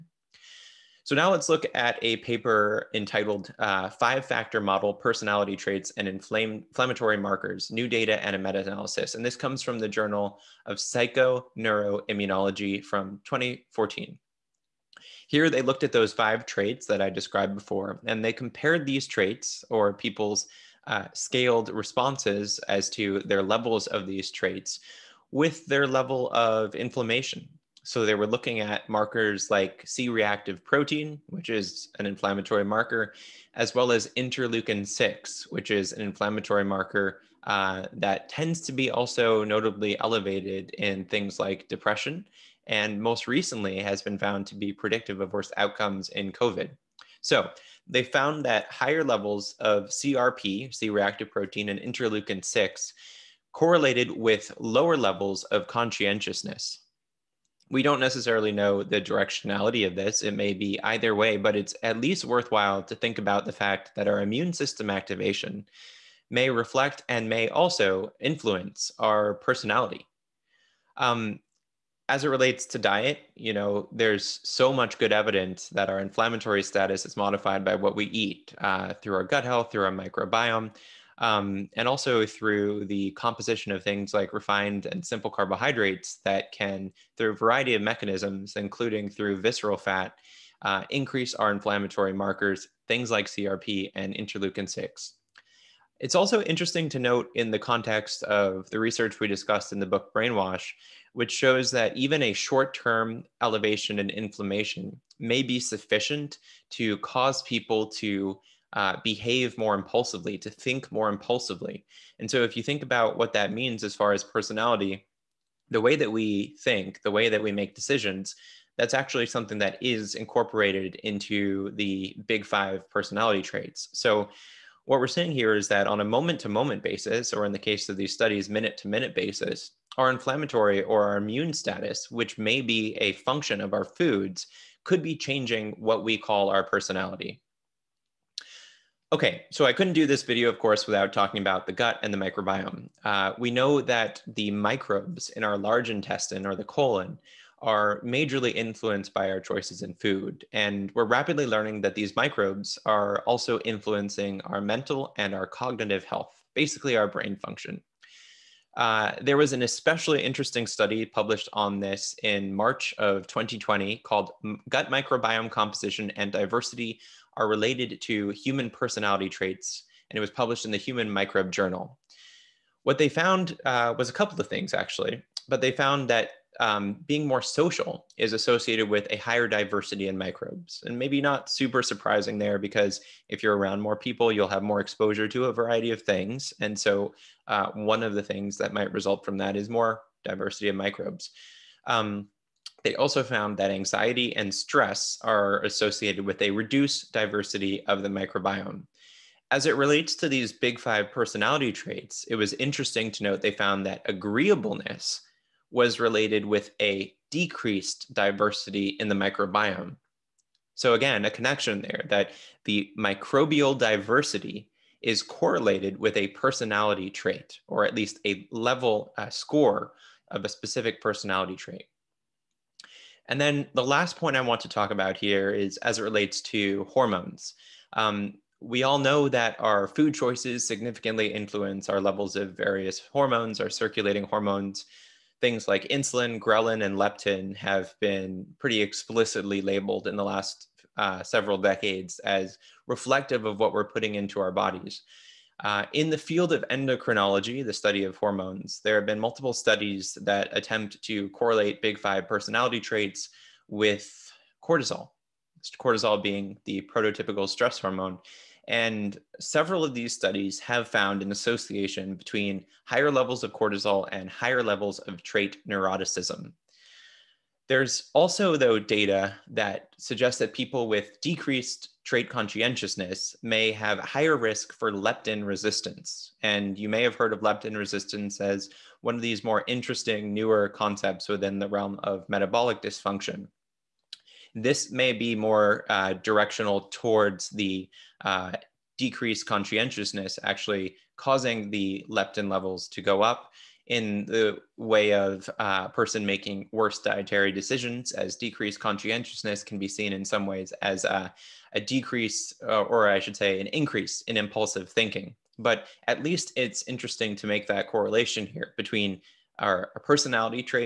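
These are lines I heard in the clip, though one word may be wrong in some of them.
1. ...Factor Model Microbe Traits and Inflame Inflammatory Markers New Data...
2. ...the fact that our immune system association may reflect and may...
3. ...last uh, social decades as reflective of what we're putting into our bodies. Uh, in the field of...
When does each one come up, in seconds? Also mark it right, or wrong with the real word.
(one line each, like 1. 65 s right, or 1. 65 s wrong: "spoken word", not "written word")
1. 4 s wrong: "Personality", not "Microbe"
2. 63 s wrong: "activation", not "association"
3. 240 s wrong: "several", not "social".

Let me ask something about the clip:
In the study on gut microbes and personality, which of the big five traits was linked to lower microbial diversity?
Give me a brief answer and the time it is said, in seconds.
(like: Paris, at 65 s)
agreeableness, at 204 s.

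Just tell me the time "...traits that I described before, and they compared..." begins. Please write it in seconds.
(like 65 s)
16 s.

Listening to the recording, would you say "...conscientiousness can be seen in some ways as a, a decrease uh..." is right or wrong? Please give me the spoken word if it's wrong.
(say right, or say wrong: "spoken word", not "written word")
right.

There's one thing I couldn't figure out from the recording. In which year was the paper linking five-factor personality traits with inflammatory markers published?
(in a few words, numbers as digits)
2014.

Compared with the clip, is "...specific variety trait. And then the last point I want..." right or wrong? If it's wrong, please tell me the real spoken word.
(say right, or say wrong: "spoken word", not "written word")
wrong: "personality", not "variety".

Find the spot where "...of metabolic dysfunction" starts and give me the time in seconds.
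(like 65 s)
282 s.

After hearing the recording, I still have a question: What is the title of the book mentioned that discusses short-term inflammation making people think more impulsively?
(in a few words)
Brainwash.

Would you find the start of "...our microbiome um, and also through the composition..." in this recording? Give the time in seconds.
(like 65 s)
79 s.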